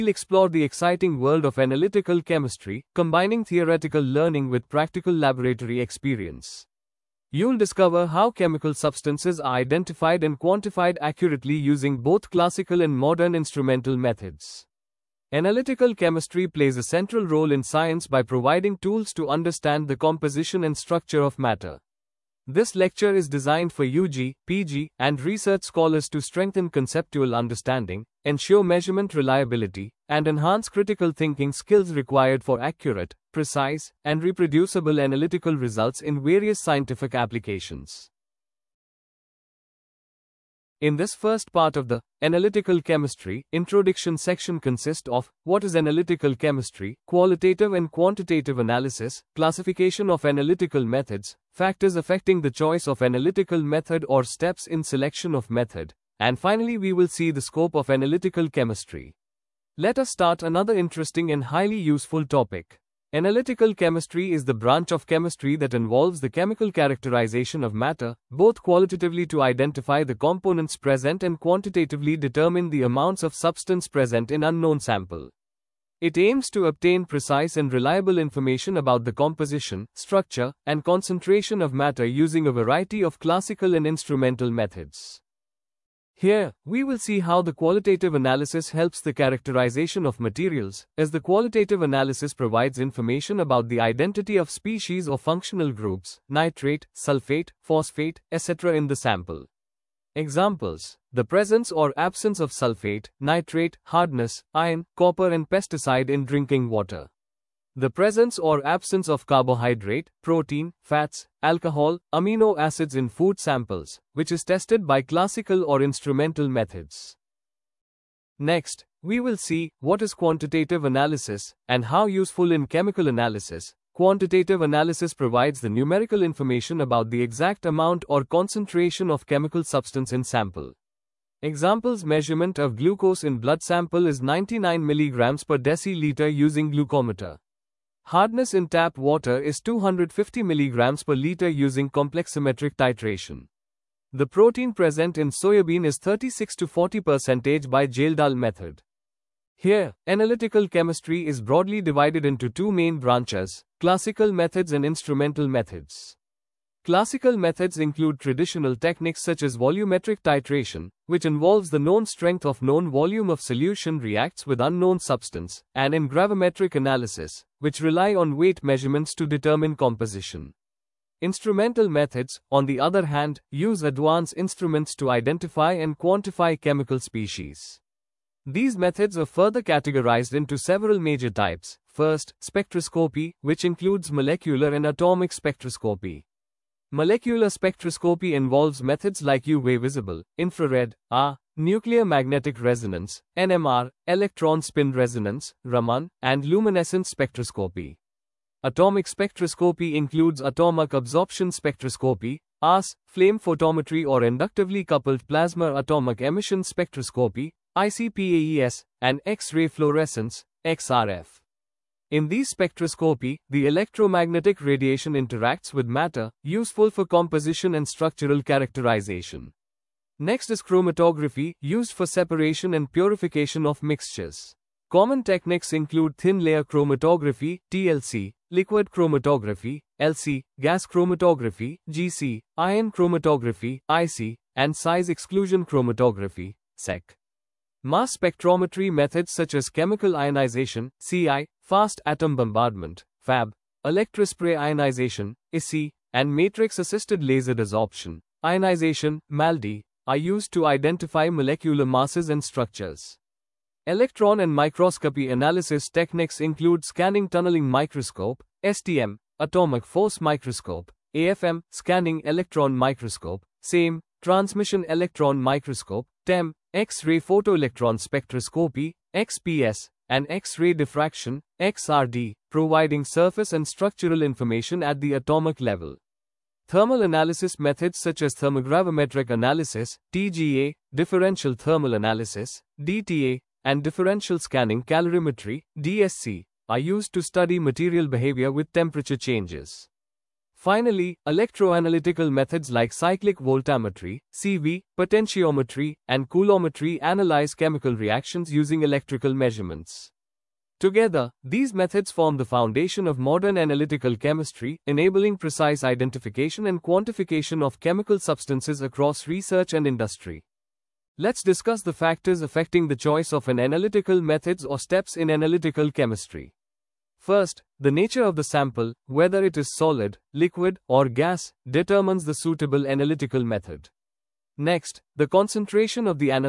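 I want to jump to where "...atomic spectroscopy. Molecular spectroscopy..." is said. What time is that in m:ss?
3:04.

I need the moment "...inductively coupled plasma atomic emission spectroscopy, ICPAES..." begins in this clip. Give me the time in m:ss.
3:24.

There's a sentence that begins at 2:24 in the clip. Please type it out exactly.
The protein present in soybean is 36 to 40% by Kjeldahl method.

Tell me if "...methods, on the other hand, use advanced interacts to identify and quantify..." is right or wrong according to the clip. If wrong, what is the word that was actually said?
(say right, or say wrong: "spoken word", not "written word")
wrong: "instruments", not "interacts".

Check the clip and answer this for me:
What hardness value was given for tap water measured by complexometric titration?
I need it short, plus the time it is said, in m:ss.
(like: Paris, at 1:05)
250 mg per liter, at 2:19.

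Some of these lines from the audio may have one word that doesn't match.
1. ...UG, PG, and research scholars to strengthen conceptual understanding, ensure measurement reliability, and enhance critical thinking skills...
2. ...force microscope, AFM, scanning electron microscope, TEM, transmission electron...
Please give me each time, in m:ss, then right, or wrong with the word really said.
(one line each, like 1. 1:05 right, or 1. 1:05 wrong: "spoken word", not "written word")
1. 0:23 right
2. 4:19 wrong: "SEM", not "TEM".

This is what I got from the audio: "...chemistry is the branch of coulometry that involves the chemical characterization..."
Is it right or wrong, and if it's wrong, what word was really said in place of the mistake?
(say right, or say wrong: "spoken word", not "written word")
wrong: "chemistry", not "coulometry".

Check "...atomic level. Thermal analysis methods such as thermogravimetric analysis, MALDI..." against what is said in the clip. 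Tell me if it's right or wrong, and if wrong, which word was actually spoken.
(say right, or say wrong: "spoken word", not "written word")
wrong: "TGA", not "MALDI".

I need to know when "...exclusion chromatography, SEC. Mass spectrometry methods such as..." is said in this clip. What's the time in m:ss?
3:55.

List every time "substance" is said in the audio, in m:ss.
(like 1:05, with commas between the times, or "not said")
0:08, 1:13, 2:09, 2:44, 5:08.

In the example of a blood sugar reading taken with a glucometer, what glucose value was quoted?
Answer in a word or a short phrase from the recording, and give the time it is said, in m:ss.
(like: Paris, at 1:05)
99 mg per deciliter, at 2:14.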